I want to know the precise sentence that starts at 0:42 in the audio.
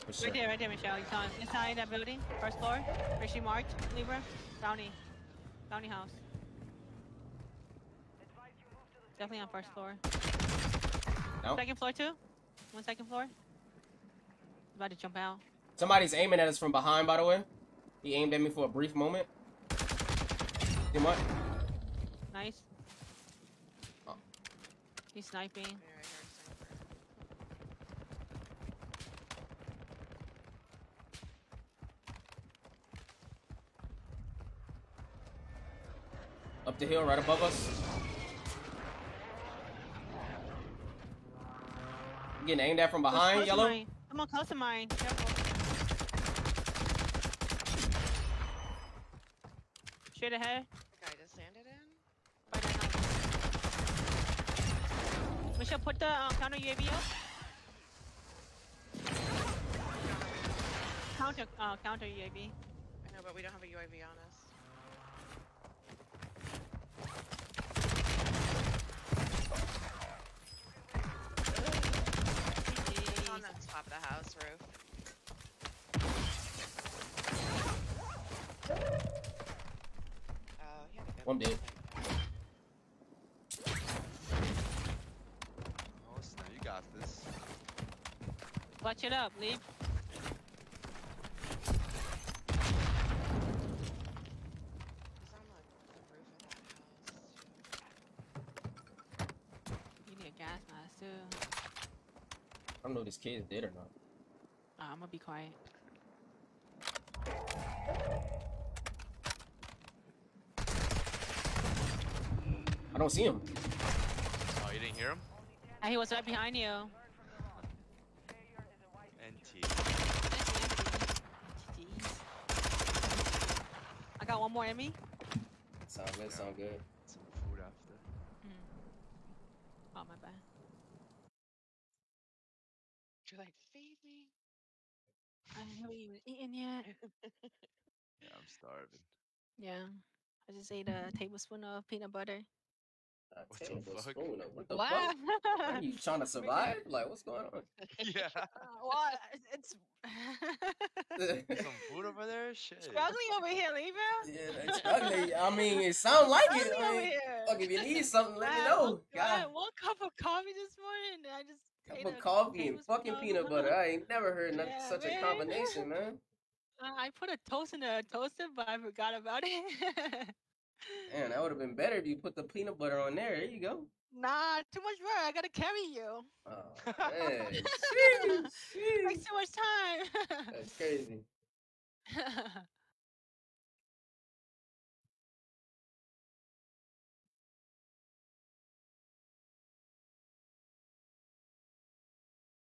I'm getting aimed at from behind, yellow.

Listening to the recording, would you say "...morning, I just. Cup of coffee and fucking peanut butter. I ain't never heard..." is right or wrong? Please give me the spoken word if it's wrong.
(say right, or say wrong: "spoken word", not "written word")
right.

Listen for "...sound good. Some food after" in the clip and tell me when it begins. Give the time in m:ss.
2:06.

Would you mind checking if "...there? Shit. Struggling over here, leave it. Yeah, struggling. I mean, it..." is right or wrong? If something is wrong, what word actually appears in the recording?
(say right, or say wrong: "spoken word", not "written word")
right.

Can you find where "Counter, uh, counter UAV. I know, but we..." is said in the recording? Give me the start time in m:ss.
1:01.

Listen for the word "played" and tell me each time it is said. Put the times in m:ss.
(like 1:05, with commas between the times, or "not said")
not said.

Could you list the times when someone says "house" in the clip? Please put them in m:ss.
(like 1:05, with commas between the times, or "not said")
0:05, 1:14.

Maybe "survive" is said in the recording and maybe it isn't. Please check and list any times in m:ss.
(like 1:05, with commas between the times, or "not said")
2:26.